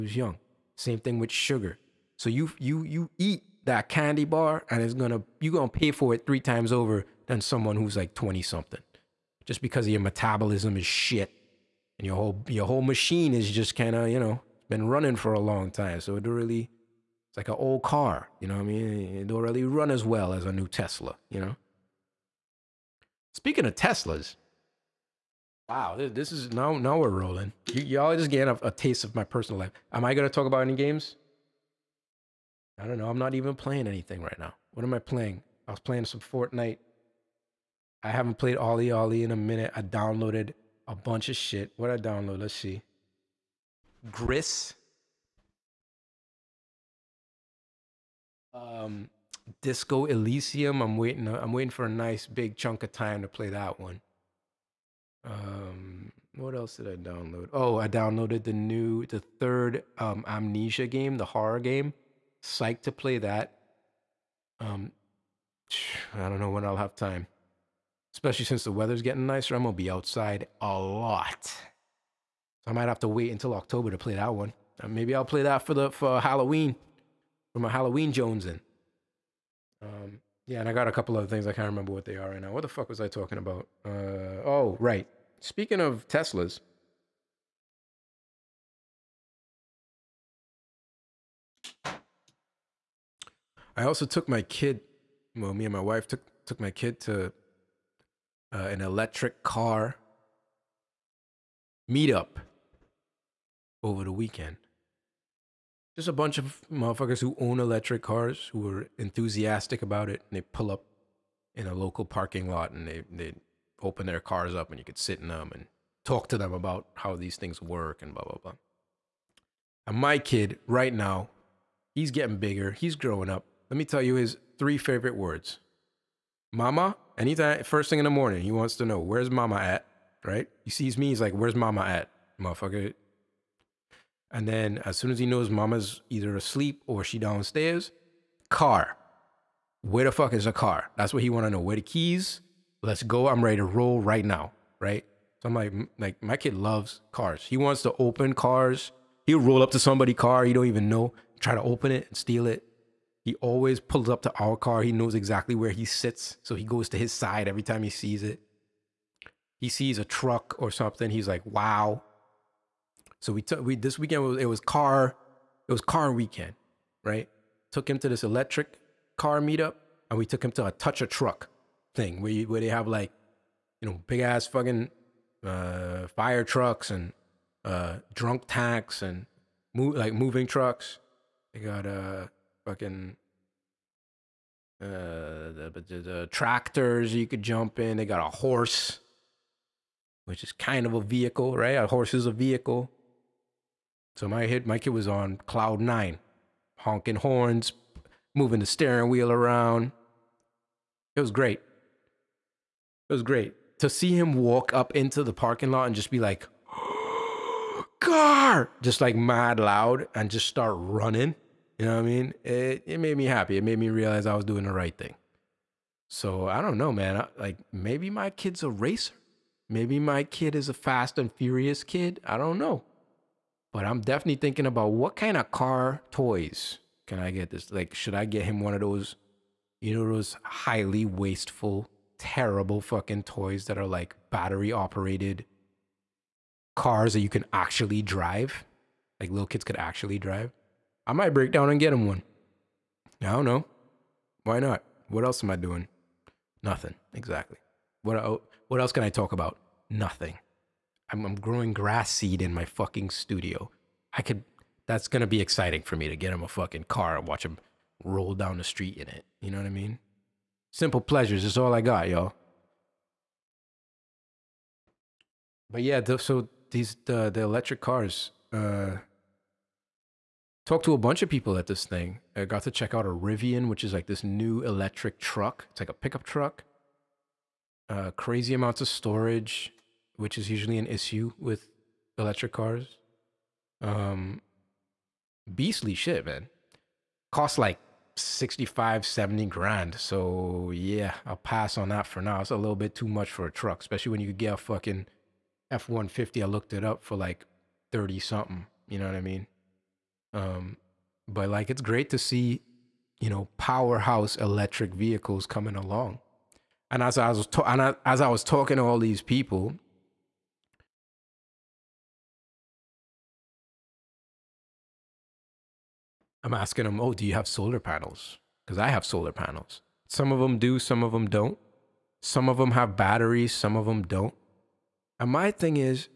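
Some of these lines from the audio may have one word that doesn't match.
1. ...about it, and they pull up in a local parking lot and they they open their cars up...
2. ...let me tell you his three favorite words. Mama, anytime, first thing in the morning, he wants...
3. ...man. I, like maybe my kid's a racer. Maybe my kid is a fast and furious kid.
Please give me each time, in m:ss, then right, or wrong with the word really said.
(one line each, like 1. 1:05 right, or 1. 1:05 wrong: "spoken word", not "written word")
1. 1:49 right
2. 2:03 right
3. 3:36 right.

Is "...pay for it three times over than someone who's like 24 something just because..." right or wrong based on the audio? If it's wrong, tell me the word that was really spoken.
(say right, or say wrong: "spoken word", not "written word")
wrong: "20", not "24".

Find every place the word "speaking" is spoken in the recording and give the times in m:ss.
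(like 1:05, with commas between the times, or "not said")
0:23, 1:25.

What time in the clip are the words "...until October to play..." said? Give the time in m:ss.
1:13.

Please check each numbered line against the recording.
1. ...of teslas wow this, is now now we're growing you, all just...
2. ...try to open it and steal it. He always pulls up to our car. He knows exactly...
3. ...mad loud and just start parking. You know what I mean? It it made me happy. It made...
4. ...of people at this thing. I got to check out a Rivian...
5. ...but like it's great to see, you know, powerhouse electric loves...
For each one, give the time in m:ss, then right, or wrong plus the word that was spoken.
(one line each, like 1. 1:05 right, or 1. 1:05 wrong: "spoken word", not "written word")
1. 0:23 wrong: "rolling", not "growing"
2. 2:31 right
3. 3:29 wrong: "running", not "parking"
4. 4:31 right
5. 5:01 wrong: "vehicles", not "loves".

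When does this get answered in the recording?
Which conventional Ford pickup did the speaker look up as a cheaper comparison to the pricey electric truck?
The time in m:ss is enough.
4:55.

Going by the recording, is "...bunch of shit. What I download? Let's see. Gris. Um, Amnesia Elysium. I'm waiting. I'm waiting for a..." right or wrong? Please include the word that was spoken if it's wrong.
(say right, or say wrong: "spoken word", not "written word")
wrong: "Disco", not "Amnesia".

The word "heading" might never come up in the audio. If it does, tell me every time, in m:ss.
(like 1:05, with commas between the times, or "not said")
not said.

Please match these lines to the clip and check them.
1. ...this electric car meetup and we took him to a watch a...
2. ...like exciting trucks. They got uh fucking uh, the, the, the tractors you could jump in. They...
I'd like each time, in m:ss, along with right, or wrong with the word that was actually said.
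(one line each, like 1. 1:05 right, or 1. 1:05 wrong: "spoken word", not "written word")
1. 2:48 wrong: "touch", not "watch"
2. 2:59 wrong: "moving", not "exciting".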